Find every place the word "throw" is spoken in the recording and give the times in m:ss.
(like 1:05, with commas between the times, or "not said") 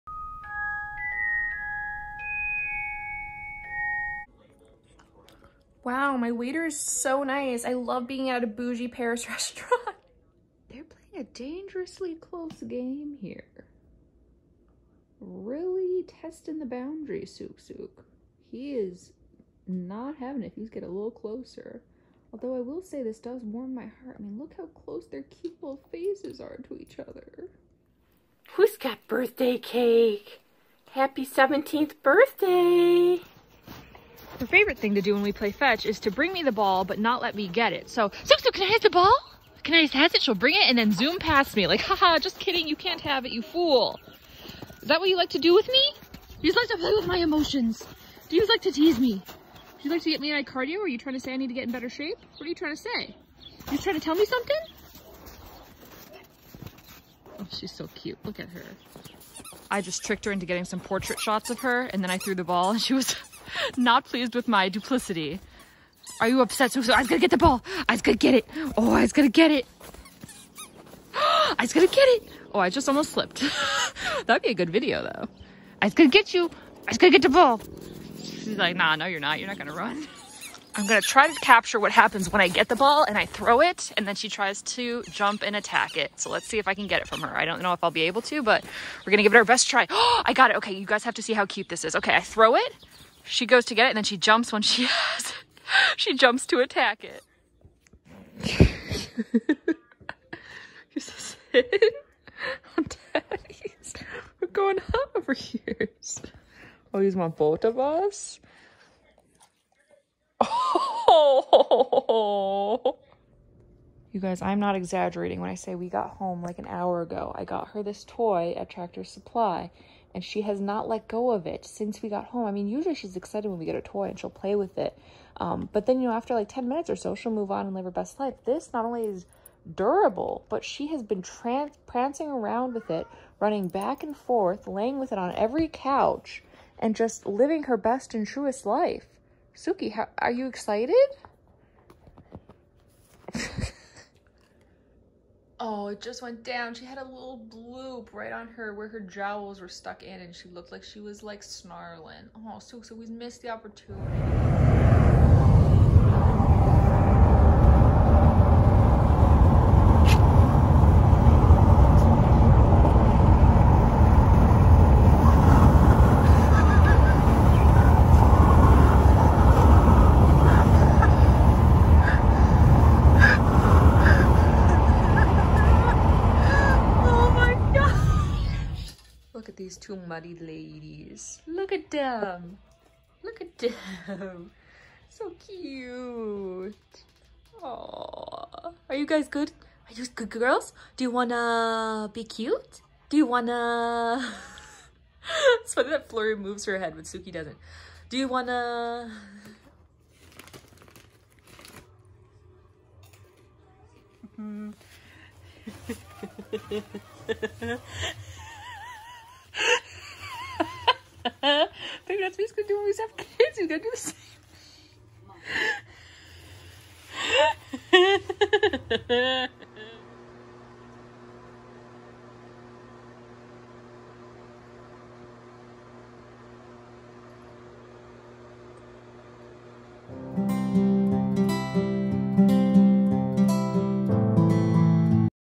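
1:23, 1:32.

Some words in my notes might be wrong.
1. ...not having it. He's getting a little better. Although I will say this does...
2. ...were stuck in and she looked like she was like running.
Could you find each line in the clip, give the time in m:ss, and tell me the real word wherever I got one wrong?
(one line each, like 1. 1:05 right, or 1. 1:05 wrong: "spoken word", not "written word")
1. 0:19 wrong: "closer", not "better"
2. 2:29 wrong: "snarling", not "running".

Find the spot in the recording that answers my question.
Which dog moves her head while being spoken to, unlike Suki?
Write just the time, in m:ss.
3:16.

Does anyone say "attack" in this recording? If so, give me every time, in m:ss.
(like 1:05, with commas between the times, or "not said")
1:25, 1:36.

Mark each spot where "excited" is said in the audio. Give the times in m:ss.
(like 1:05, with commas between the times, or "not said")
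2:03, 2:20.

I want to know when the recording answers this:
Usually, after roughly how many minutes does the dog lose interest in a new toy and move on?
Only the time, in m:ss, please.
2:06.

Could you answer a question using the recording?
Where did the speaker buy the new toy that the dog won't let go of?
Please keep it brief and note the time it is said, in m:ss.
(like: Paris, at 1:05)
Tractor Supply, at 1:58.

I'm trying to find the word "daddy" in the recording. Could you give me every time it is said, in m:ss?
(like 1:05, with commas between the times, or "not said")
1:43.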